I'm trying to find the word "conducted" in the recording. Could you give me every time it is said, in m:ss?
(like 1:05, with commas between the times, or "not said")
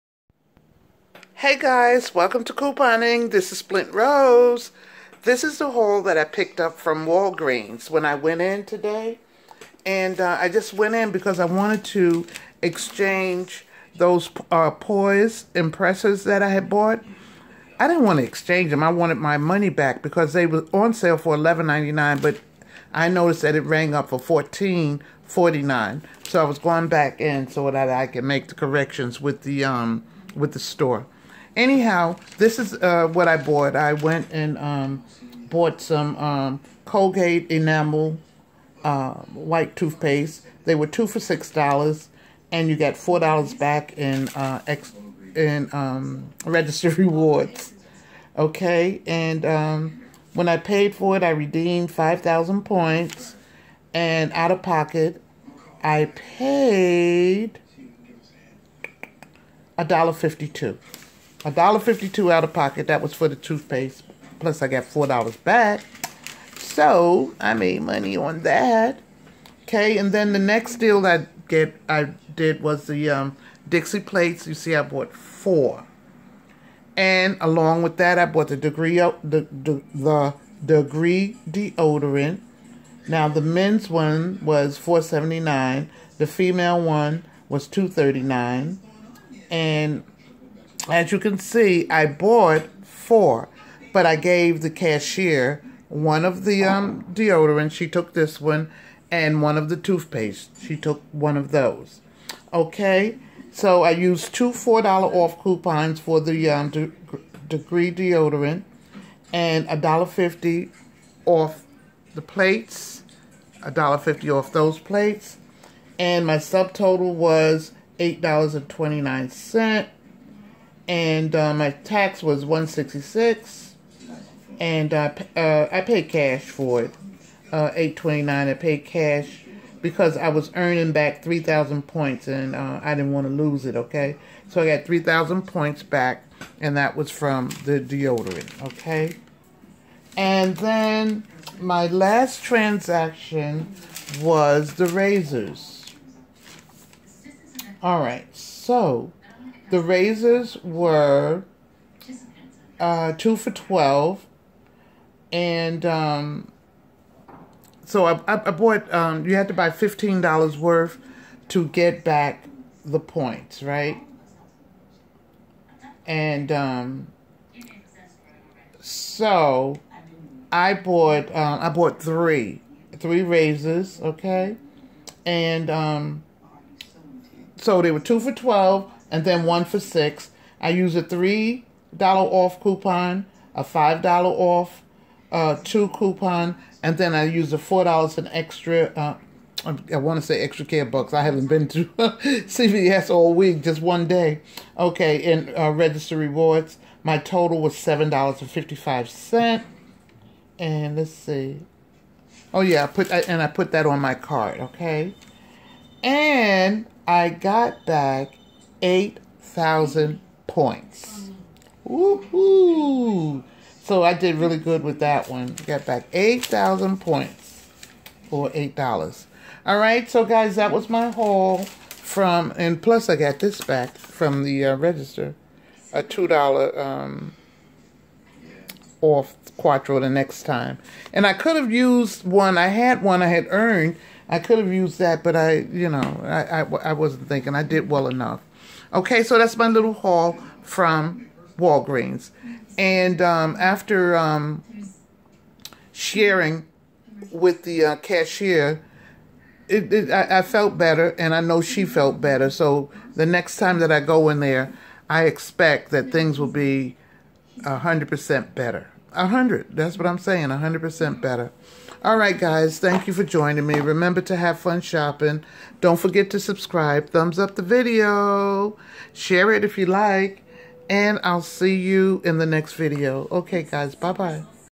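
not said.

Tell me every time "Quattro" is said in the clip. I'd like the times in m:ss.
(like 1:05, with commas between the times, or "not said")
3:49.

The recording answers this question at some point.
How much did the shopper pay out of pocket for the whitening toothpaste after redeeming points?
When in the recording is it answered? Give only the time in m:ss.
1:01.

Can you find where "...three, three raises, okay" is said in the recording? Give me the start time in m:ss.
2:52.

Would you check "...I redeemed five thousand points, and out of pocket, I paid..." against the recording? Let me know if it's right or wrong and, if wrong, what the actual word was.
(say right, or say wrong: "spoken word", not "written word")
right.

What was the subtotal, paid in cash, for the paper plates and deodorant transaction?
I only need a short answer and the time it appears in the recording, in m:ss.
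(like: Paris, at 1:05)
$8.29, at 1:57.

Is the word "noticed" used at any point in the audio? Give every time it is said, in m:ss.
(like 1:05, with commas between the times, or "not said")
0:23.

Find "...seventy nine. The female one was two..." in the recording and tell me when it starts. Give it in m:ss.
1:25.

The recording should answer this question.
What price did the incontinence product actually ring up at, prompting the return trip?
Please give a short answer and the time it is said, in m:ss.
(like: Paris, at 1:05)
$14.49, at 0:24.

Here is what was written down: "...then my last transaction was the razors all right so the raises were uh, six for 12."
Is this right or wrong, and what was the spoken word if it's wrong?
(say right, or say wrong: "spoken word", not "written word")
wrong: "two", not "six".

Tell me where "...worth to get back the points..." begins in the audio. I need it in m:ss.
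2:40.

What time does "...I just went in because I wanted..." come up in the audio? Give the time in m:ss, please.
0:10.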